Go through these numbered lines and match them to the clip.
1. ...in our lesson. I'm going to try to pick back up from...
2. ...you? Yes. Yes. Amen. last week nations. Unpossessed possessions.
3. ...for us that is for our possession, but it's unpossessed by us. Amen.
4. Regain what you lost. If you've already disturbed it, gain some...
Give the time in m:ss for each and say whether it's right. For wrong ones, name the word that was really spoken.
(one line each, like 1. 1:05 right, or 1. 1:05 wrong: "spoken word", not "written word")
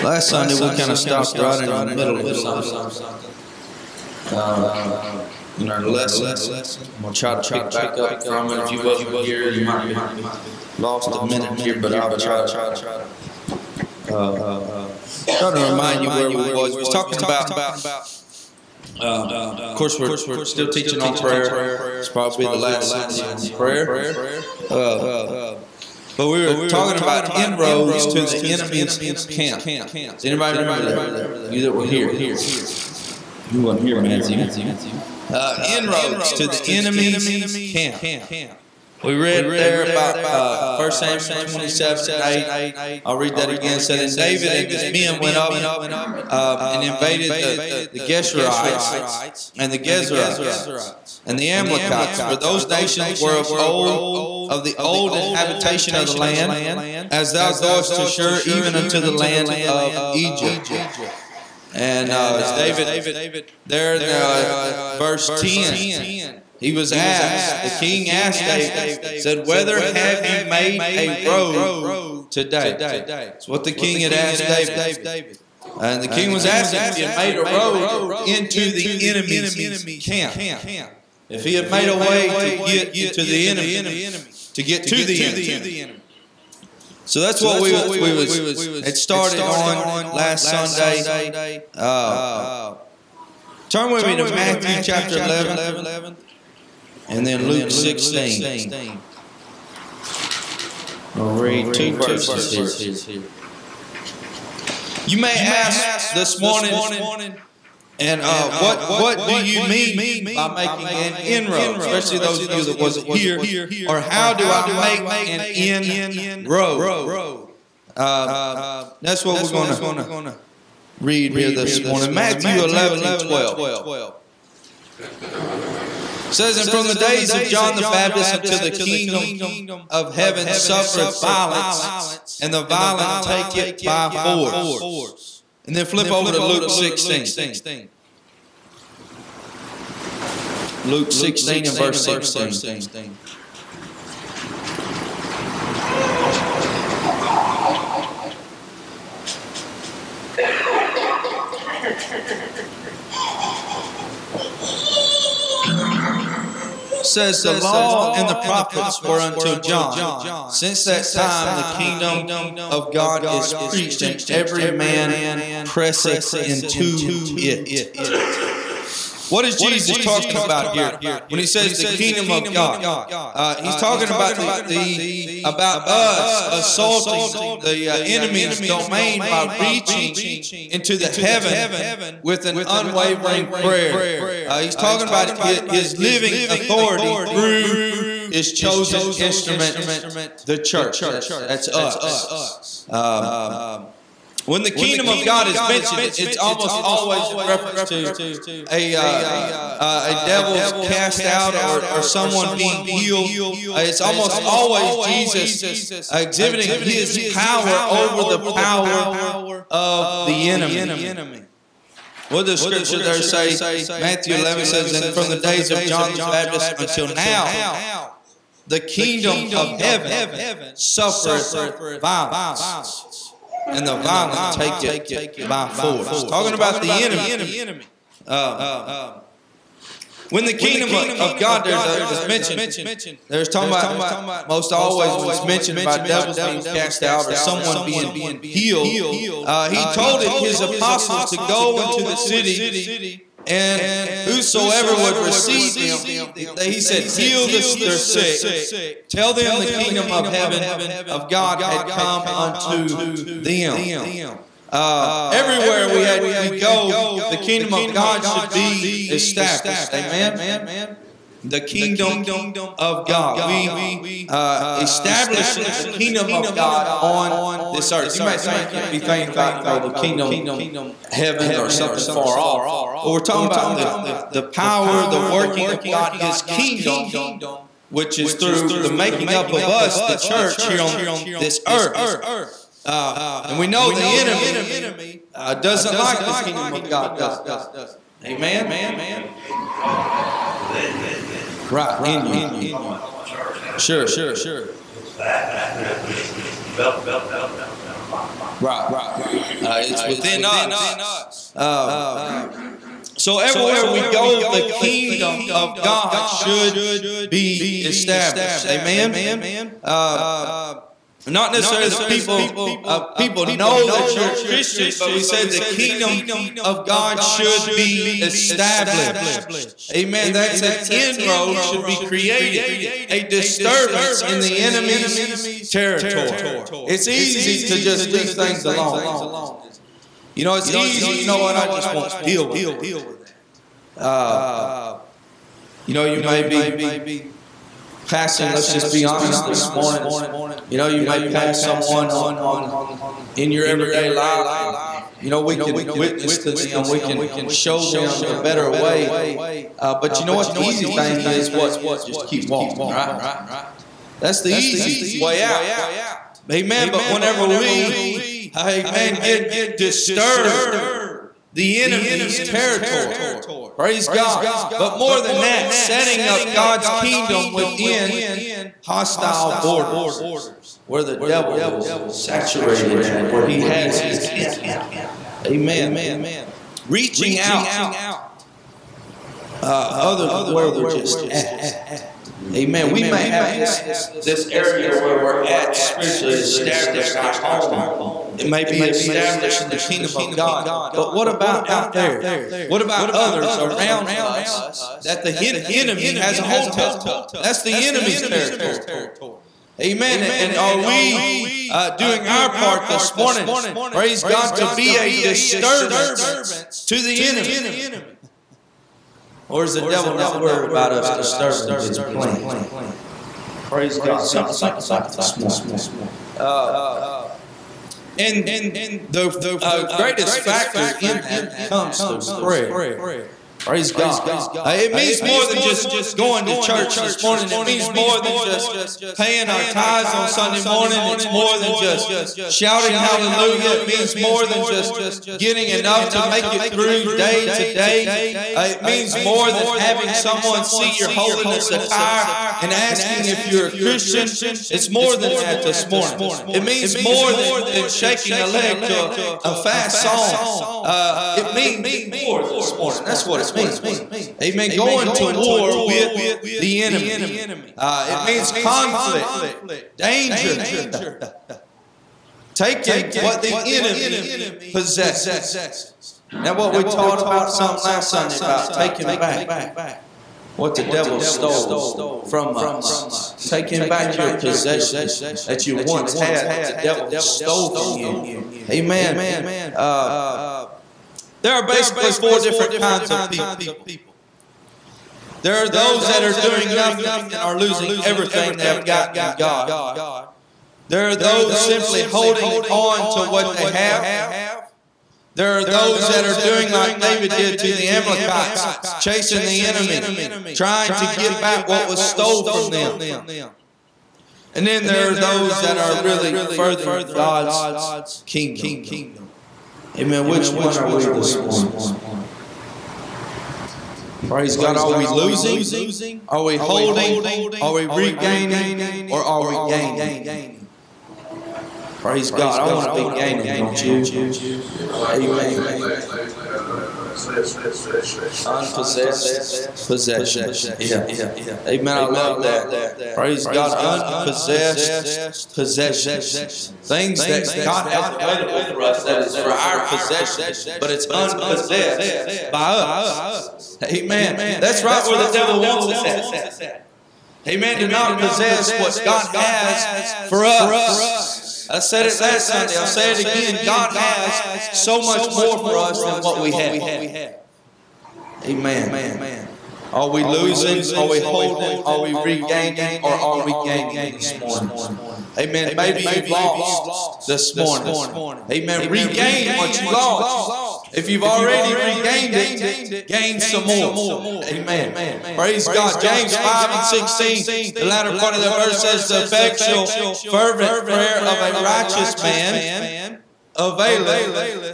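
1. 0:05 right
2. 8:43 wrong: "possessions", not "nations"
3. 8:58 right
4. 9:28 wrong: "regained", not "disturbed".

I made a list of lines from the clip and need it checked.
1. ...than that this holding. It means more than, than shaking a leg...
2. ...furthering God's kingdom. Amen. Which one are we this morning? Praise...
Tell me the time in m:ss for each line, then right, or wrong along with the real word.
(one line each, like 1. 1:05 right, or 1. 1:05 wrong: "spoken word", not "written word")
1. 7:25 wrong: "morning", not "holding"
2. 8:26 right.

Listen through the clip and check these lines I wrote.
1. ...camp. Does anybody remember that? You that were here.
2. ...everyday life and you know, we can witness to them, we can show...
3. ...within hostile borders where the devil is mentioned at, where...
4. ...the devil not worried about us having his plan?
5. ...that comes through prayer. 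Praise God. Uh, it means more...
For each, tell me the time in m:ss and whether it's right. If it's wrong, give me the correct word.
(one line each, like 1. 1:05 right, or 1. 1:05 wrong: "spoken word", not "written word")
1. 0:29 right
2. 5:43 right
3. 6:07 wrong: "saturated", not "mentioned"
4. 6:49 wrong: "disturbing", not "having"
5. 7:01 right.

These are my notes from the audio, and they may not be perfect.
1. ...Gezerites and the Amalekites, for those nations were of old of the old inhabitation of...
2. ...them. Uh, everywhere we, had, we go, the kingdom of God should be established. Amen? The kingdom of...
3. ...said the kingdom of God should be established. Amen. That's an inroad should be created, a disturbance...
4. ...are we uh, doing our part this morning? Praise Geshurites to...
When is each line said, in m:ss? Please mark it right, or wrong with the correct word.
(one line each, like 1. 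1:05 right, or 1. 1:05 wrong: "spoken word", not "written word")
1. 0:49 right
2. 4:13 right
3. 5:15 right
4. 6:40 wrong: "God", not "Geshurites".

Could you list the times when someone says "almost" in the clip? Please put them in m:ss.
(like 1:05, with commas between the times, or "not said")
3:16, 3:23.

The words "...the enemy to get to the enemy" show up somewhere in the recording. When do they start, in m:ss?
1:23.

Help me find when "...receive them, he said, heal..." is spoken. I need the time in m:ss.
4:05.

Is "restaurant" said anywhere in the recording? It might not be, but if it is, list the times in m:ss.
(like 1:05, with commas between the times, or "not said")
not said.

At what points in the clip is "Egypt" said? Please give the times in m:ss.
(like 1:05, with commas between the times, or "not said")
1:00.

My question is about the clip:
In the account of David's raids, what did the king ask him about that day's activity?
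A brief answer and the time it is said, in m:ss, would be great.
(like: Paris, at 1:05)
Whether have you made a road today?, at 1:09.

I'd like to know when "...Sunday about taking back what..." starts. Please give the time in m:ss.
7:48.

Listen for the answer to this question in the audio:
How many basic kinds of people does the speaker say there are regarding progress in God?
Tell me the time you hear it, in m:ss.
8:02.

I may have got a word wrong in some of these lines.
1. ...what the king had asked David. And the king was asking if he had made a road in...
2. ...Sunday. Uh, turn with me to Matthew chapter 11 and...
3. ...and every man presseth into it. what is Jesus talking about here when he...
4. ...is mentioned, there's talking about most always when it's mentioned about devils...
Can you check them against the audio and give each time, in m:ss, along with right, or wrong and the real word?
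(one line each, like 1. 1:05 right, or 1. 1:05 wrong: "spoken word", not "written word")
1. 1:13 right
2. 1:30 right
3. 2:44 right
4. 3:52 right.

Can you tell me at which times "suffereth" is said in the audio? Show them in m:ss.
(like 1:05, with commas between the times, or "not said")
2:10, 3:40.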